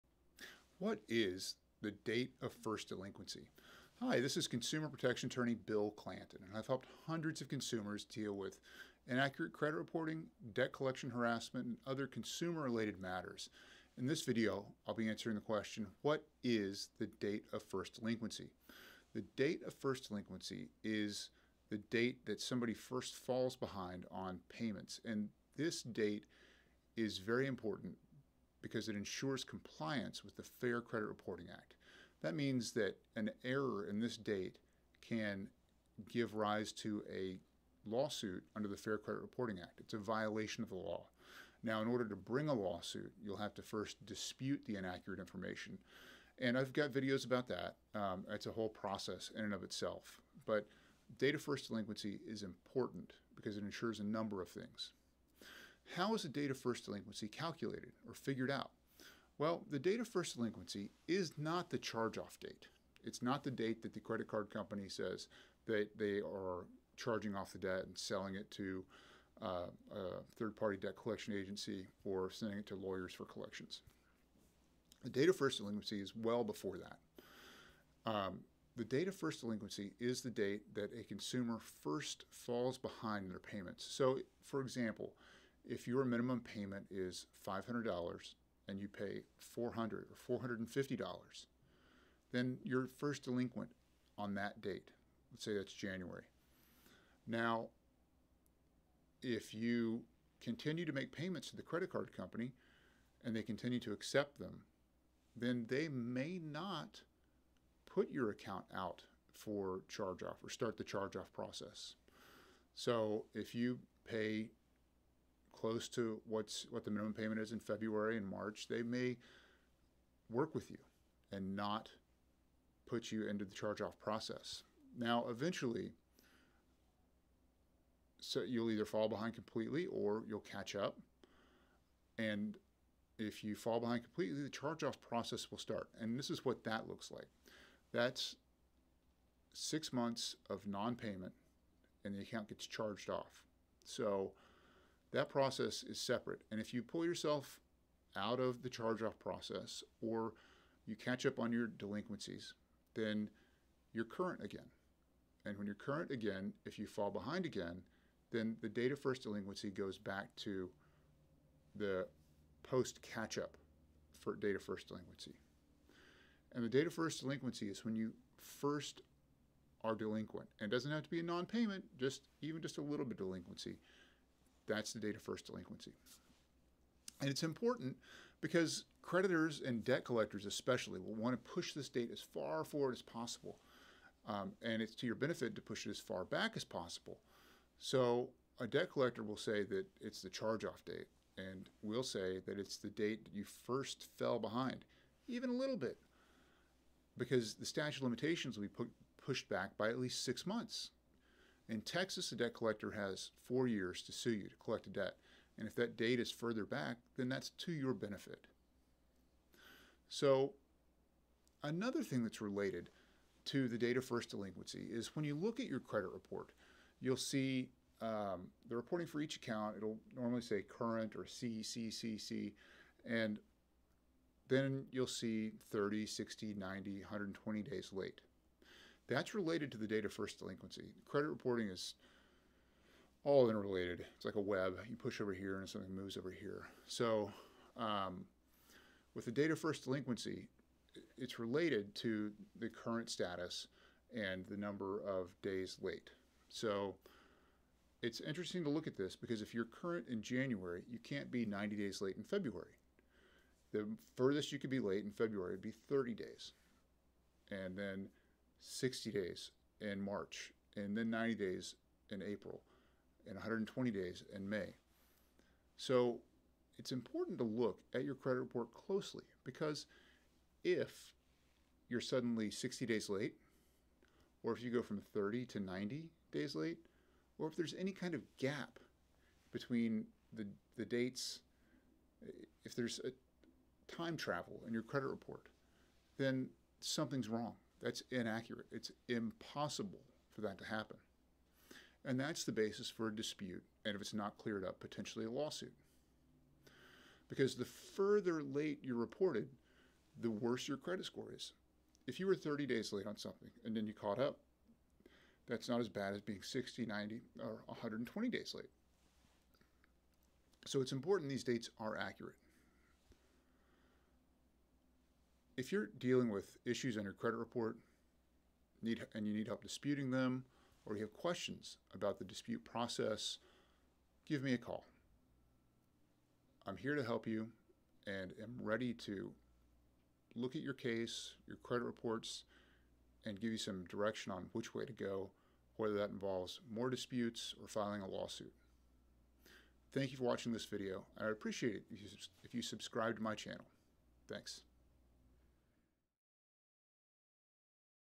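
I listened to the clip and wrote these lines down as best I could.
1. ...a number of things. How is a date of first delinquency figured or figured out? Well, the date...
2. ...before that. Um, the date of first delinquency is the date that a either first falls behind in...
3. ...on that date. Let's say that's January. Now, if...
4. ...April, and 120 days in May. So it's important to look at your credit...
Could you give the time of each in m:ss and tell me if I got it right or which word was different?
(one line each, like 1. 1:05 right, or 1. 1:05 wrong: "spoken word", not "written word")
1. 0:53 wrong: "calculated", not "figured"
2. 1:16 wrong: "consumer", not "either"
3. 1:34 right
4. 4:22 right.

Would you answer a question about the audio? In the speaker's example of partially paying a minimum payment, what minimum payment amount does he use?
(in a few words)
$500.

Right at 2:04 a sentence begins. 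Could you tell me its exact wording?
Now, eventually, so you'll either fall behind completely or you'll catch up.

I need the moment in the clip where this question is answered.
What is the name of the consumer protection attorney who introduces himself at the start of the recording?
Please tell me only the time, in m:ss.
0:05.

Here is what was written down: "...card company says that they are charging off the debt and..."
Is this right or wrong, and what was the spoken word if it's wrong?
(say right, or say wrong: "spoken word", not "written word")
right.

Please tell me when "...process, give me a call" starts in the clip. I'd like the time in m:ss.
5:22.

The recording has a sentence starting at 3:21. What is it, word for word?
In Texas, a debt collector has four years to sue you to collect a debt.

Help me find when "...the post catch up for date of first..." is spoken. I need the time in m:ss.
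2:41.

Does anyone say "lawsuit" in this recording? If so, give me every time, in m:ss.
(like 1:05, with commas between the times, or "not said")
0:37, 0:42, 4:55, 5:38.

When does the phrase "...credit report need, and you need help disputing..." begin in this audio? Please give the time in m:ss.
5:17.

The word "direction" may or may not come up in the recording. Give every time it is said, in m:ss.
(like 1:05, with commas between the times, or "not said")
5:33.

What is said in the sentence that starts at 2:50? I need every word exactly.
And it doesn't have to be a non payment, just even just a little bit of delinquency.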